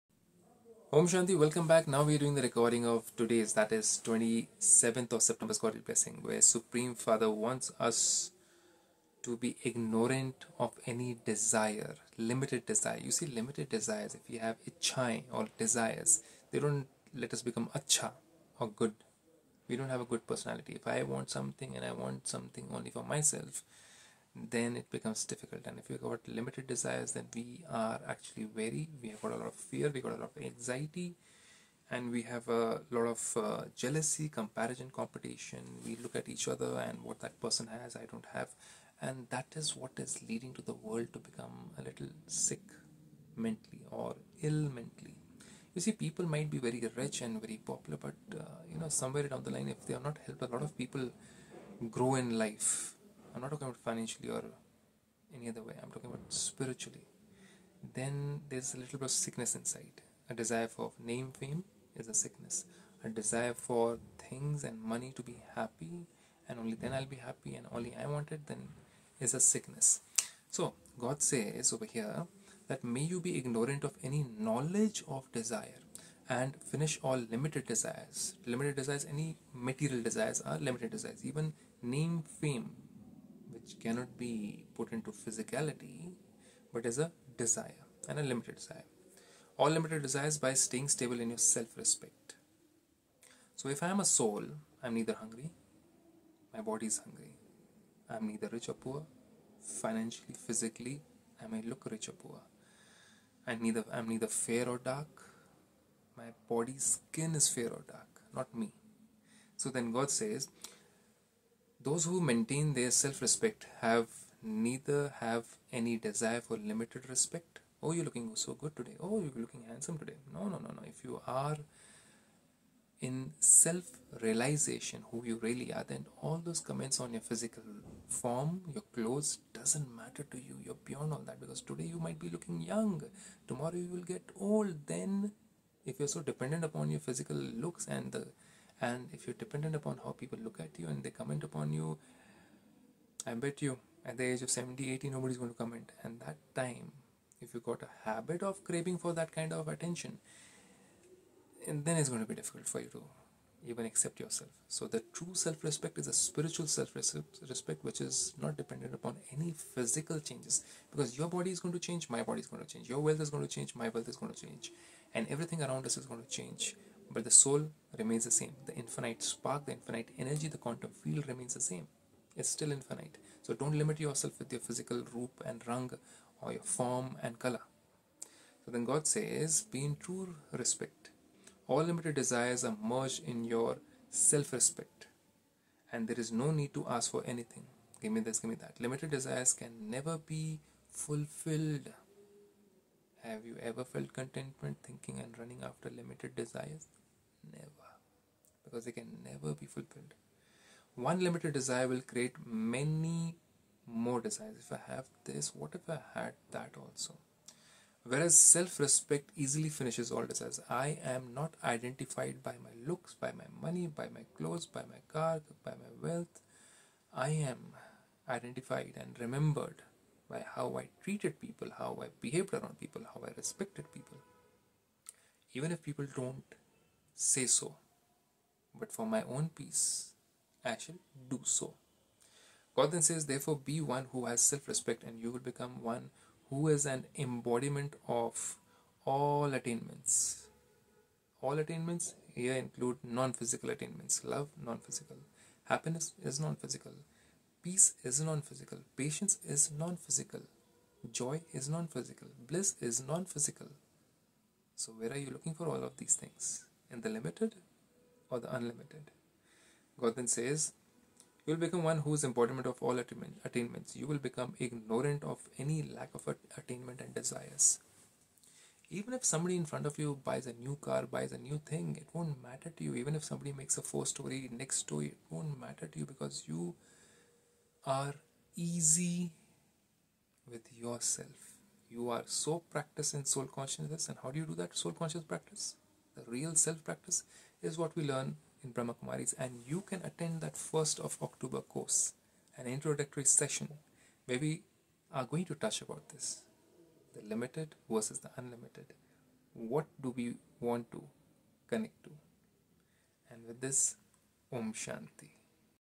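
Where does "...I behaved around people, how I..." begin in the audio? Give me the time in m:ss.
3:42.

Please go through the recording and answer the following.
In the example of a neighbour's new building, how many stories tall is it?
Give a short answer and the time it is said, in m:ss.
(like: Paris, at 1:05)
four, at 4:33.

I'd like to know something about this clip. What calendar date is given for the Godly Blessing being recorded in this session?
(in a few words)
27th of September.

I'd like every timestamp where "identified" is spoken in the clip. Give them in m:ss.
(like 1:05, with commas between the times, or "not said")
3:31, 3:38.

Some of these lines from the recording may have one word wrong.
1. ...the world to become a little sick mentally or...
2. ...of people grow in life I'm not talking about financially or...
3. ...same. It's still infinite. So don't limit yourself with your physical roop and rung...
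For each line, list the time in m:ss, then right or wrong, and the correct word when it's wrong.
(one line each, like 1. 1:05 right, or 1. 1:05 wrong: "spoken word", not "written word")
1. 0:40 right
2. 0:50 right
3. 2:51 right.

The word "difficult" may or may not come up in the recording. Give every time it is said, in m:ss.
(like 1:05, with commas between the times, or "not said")
0:25, 2:32.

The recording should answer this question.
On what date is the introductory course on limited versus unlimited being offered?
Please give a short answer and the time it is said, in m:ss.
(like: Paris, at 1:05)
1st of October, at 4:50.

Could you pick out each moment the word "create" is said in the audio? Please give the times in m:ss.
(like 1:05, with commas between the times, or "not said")
3:22.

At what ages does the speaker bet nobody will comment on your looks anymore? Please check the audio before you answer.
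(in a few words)
70 80.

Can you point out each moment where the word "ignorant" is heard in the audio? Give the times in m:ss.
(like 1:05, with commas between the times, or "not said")
0:09, 1:13, 4:24.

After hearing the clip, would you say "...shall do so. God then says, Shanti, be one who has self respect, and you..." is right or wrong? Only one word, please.
wrong.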